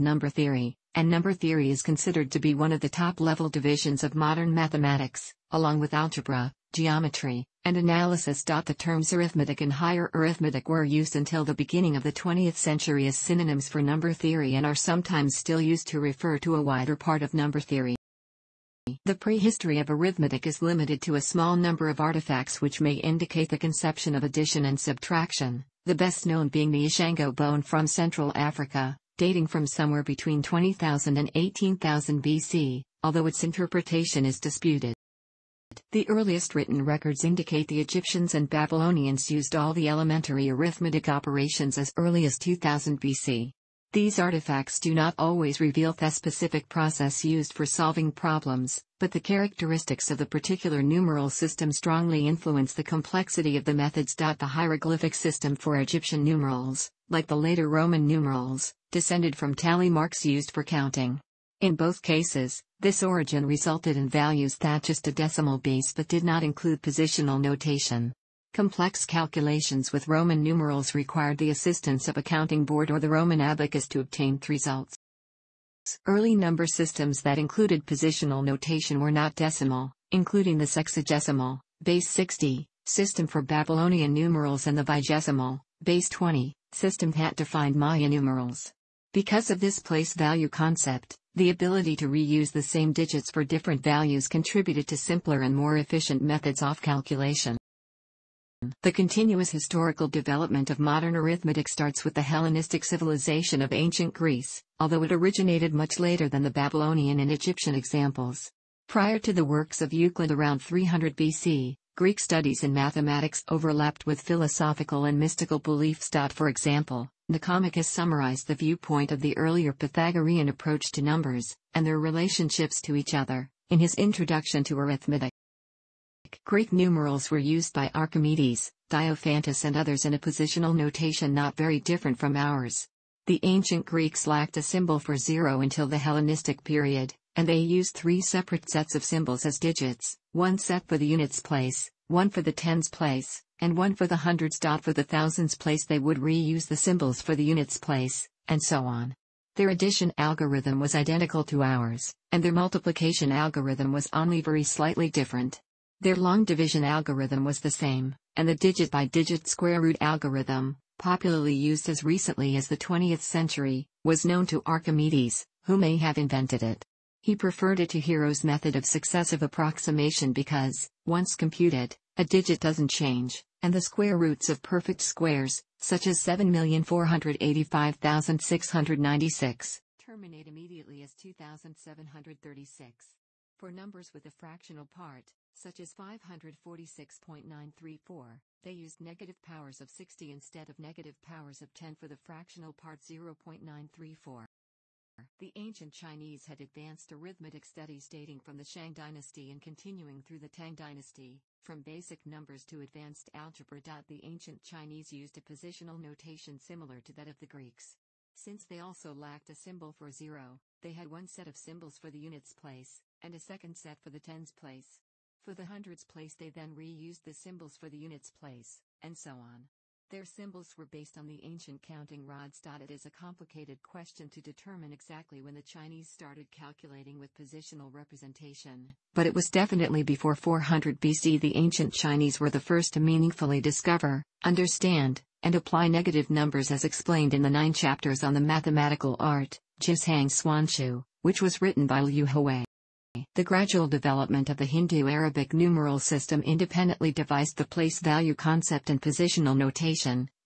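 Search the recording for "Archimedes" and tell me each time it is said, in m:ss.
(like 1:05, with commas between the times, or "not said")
2:07, 2:44.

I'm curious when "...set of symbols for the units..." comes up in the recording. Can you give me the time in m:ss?
3:31.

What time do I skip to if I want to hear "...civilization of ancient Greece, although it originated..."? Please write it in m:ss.
1:42.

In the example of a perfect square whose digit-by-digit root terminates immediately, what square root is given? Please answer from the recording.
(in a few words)
2,736.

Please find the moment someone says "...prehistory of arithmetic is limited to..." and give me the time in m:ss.
0:19.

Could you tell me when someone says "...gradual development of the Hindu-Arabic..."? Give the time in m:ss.
4:03.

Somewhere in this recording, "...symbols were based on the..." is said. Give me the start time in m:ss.
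3:40.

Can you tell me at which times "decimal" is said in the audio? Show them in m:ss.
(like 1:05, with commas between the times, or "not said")
1:05, 1:19.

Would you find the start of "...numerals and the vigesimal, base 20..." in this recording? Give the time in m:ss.
1:24.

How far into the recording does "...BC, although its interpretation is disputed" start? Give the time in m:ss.
0:32.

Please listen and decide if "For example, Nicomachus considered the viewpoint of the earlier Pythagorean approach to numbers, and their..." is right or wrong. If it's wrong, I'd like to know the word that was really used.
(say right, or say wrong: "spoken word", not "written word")
wrong: "summarized", not "considered".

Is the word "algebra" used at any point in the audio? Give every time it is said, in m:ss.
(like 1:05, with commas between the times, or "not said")
0:05, 3:23.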